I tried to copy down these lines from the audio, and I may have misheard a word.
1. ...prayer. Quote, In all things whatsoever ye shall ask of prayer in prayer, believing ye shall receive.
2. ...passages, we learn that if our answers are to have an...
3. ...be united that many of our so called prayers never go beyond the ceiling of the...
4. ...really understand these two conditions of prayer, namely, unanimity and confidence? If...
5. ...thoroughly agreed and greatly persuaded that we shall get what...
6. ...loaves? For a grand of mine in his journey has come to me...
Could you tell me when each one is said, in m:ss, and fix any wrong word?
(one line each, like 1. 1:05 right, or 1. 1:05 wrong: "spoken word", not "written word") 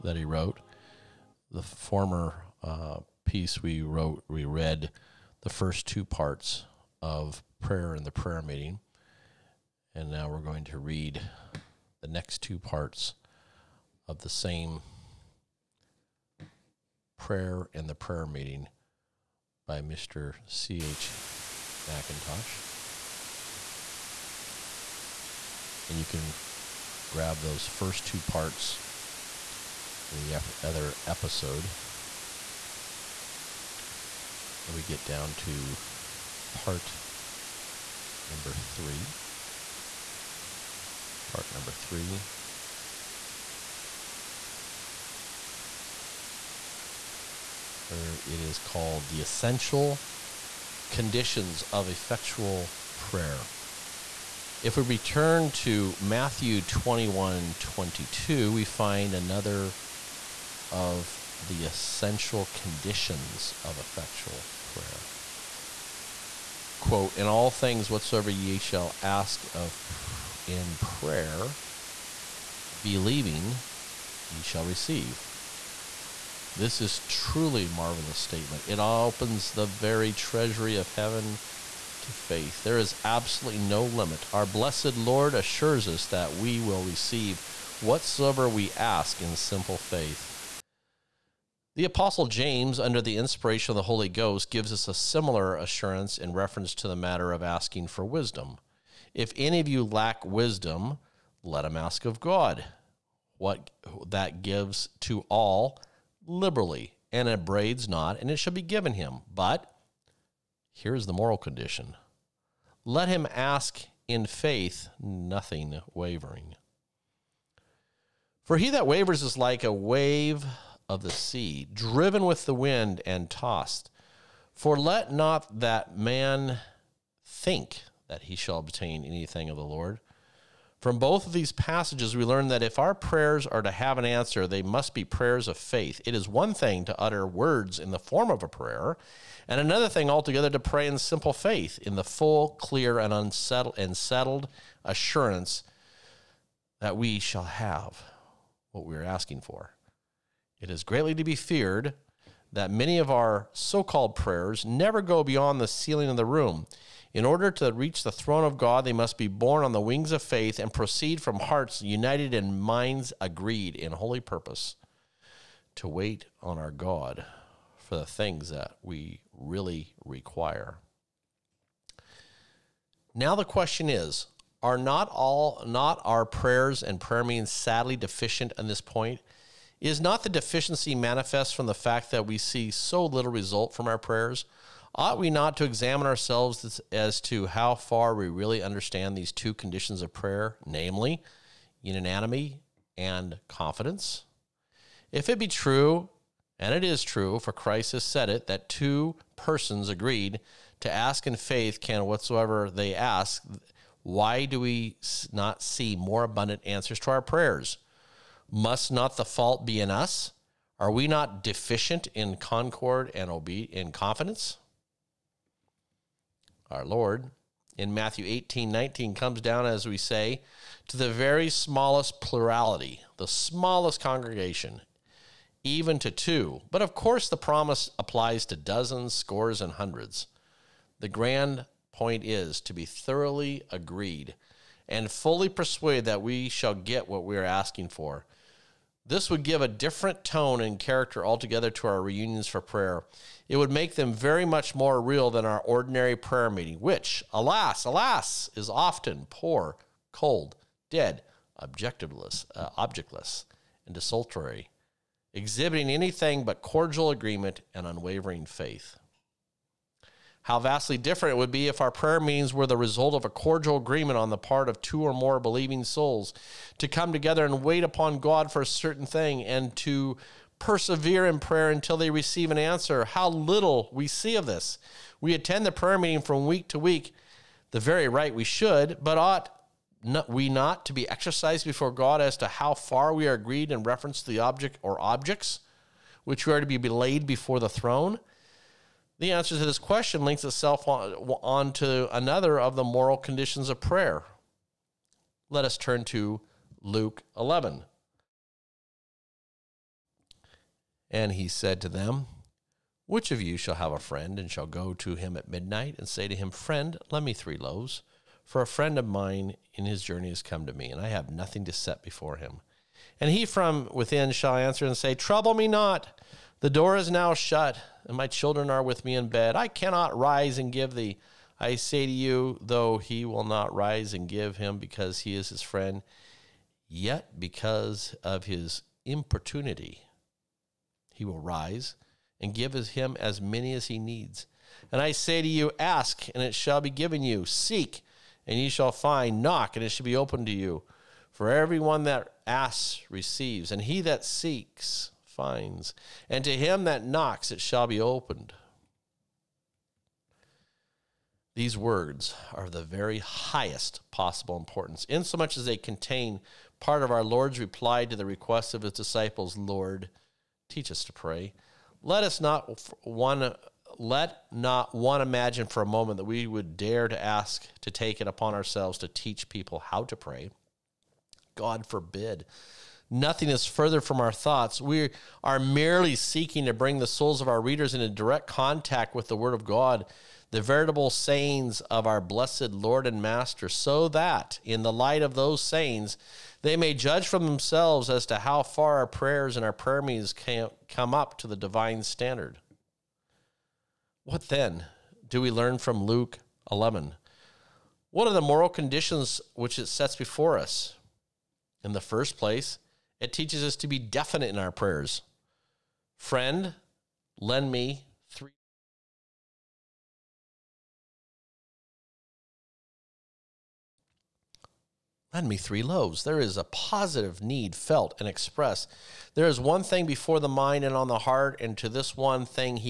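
1. 1:04 right
2. 2:11 wrong: "prayers", not "answers"
3. 2:31 wrong: "feared", not "united"
4. 3:08 right
5. 3:52 wrong: "fully", not "greatly"
6. 5:07 wrong: "friend", not "grand".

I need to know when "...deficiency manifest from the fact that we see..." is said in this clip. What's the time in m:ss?
3:00.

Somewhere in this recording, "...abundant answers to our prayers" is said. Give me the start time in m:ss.
3:26.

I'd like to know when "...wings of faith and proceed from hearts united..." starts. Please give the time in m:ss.
2:39.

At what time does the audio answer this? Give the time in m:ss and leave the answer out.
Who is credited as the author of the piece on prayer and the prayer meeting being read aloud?
0:19.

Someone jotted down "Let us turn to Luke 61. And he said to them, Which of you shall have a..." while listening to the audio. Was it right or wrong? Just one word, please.
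wrong.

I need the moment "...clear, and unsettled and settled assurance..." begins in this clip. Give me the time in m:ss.
2:22.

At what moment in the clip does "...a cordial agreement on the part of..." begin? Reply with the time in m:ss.
4:23.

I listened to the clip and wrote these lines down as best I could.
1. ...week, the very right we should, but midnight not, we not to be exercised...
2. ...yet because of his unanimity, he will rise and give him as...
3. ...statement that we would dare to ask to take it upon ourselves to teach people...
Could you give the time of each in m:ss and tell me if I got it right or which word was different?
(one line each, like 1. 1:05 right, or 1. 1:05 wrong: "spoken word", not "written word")
1. 4:36 wrong: "ought", not "midnight"
2. 5:26 wrong: "importunity", not "unanimity"
3. 6:05 wrong: "moment", not "statement".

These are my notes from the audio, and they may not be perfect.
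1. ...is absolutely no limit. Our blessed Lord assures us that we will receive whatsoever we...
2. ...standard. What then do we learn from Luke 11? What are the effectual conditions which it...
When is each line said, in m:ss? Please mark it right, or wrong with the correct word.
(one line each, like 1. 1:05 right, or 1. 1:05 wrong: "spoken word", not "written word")
1. 1:22 right
2. 6:32 wrong: "moral", not "effectual".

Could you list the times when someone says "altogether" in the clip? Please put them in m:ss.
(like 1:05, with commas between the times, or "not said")
2:20, 4:01.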